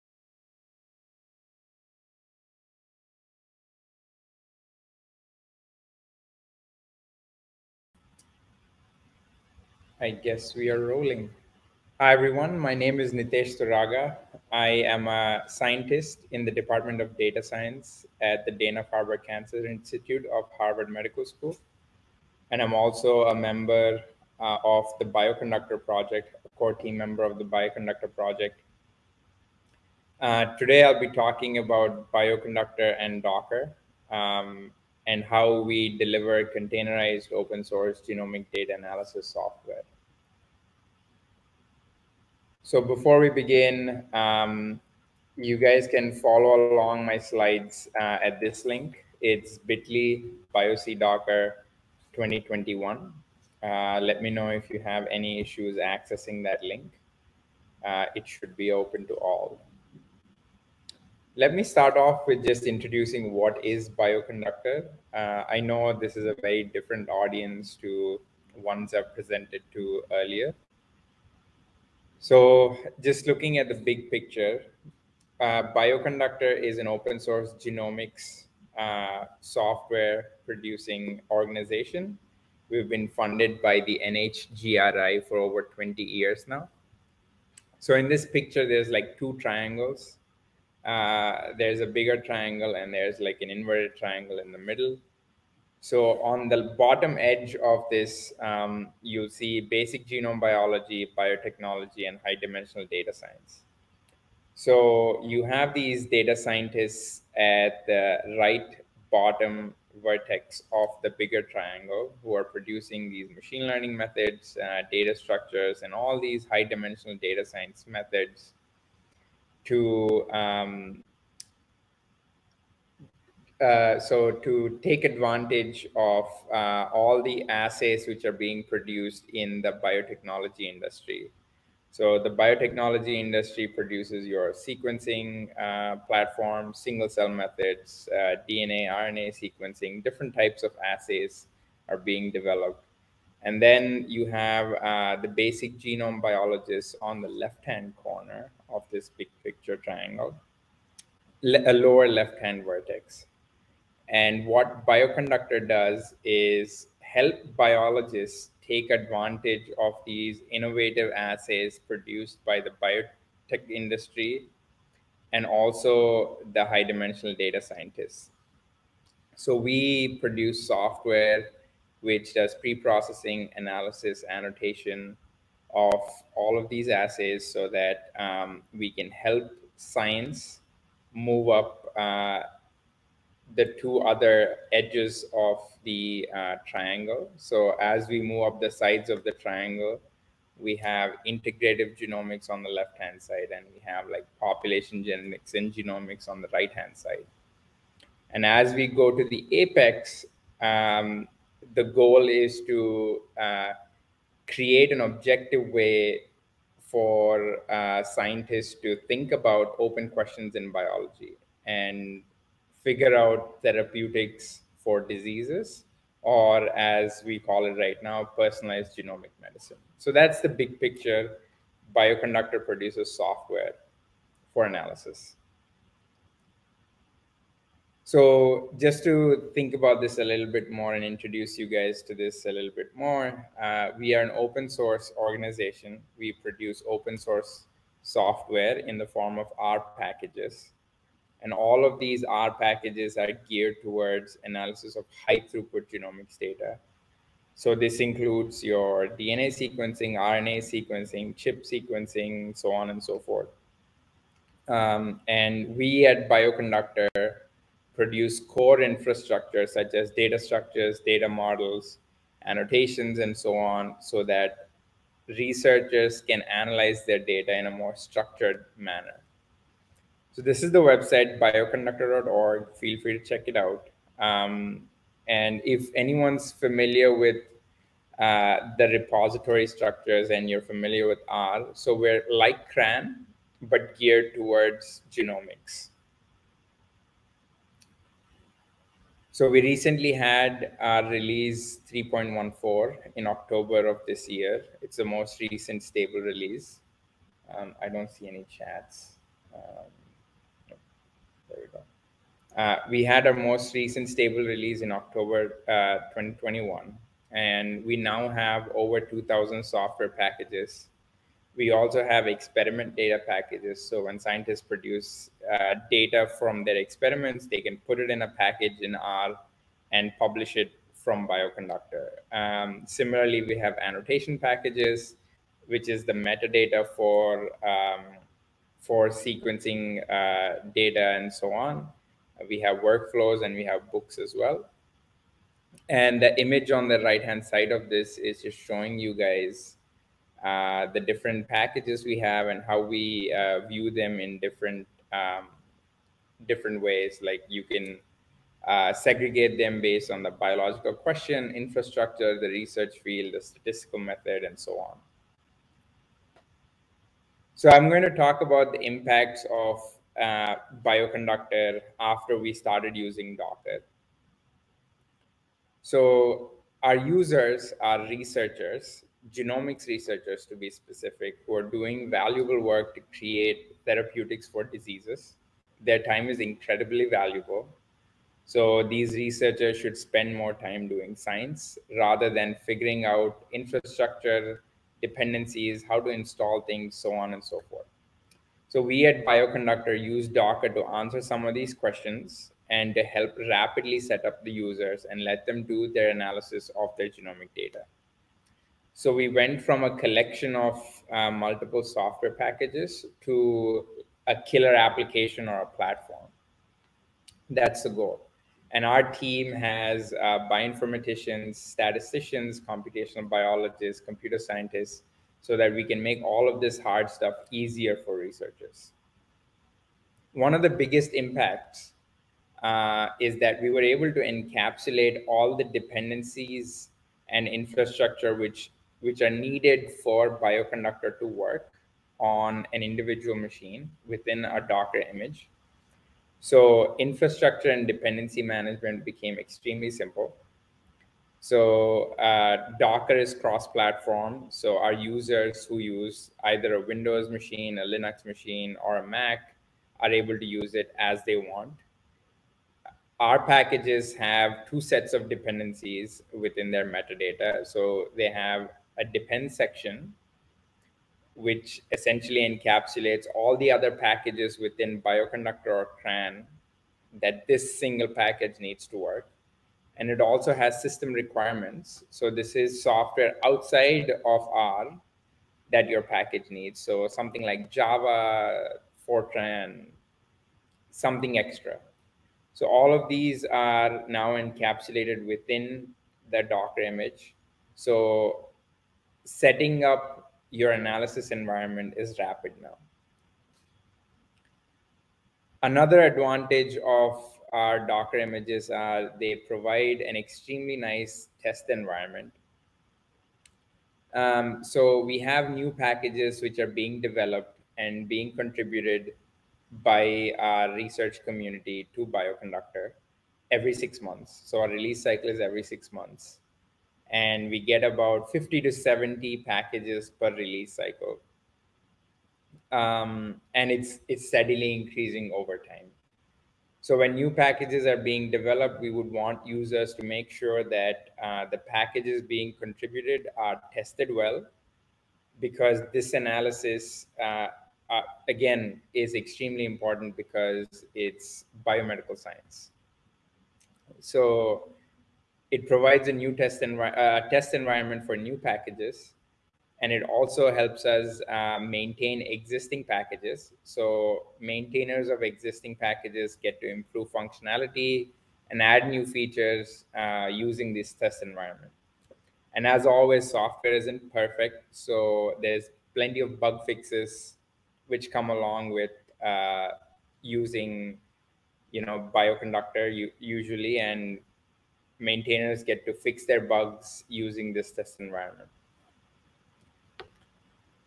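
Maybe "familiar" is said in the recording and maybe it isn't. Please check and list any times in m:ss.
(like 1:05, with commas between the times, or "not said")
4:36, 4:40.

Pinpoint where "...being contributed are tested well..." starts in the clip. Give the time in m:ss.
8:52.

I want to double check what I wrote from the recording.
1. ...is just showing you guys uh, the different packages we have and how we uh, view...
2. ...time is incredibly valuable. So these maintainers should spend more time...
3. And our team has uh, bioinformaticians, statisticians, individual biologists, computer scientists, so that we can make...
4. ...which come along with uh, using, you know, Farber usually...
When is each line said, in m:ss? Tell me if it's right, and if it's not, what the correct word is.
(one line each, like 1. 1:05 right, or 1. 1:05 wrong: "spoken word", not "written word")
1. 5:38 right
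2. 6:15 wrong: "researchers", not "maintainers"
3. 6:48 wrong: "computational", not "individual"
4. 9:27 wrong: "Bioconductor", not "Farber".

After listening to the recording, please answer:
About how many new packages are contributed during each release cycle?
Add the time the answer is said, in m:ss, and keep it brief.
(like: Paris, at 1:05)
50 to 70, at 8:38.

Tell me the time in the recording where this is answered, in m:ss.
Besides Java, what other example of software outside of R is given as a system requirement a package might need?
7:59.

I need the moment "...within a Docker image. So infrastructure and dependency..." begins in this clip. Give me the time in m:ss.
7:14.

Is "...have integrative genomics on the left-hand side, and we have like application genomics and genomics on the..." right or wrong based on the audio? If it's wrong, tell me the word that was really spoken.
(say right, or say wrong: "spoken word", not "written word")
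wrong: "population", not "application".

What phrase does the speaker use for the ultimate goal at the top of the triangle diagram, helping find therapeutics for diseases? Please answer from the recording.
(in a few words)
personalized genomic medicine.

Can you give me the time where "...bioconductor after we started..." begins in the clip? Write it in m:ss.
6:00.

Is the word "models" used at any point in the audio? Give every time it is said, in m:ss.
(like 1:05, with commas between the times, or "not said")
4:21.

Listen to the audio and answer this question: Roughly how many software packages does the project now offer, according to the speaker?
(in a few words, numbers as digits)
over 2,000.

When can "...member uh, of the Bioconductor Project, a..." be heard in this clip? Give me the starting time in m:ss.
0:23.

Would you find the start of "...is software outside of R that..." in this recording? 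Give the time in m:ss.
7:52.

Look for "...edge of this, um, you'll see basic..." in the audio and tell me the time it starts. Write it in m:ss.
1:37.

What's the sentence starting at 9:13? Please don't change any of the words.
So maintainers of existing packages get to improve functionality and add new features uh, using this test environment.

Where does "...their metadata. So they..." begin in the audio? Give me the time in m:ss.
7:36.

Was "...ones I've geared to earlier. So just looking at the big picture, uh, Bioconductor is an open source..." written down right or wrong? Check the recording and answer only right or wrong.
wrong.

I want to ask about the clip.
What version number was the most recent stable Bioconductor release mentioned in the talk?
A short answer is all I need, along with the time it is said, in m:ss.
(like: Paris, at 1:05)
3.14, at 4:51.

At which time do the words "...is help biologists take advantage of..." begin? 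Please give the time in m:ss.
2:36.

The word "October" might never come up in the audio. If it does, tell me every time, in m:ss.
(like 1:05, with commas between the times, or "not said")
4:53, 5:04.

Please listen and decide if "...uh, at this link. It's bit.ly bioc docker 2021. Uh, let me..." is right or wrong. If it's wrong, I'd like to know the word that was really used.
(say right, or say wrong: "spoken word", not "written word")
right.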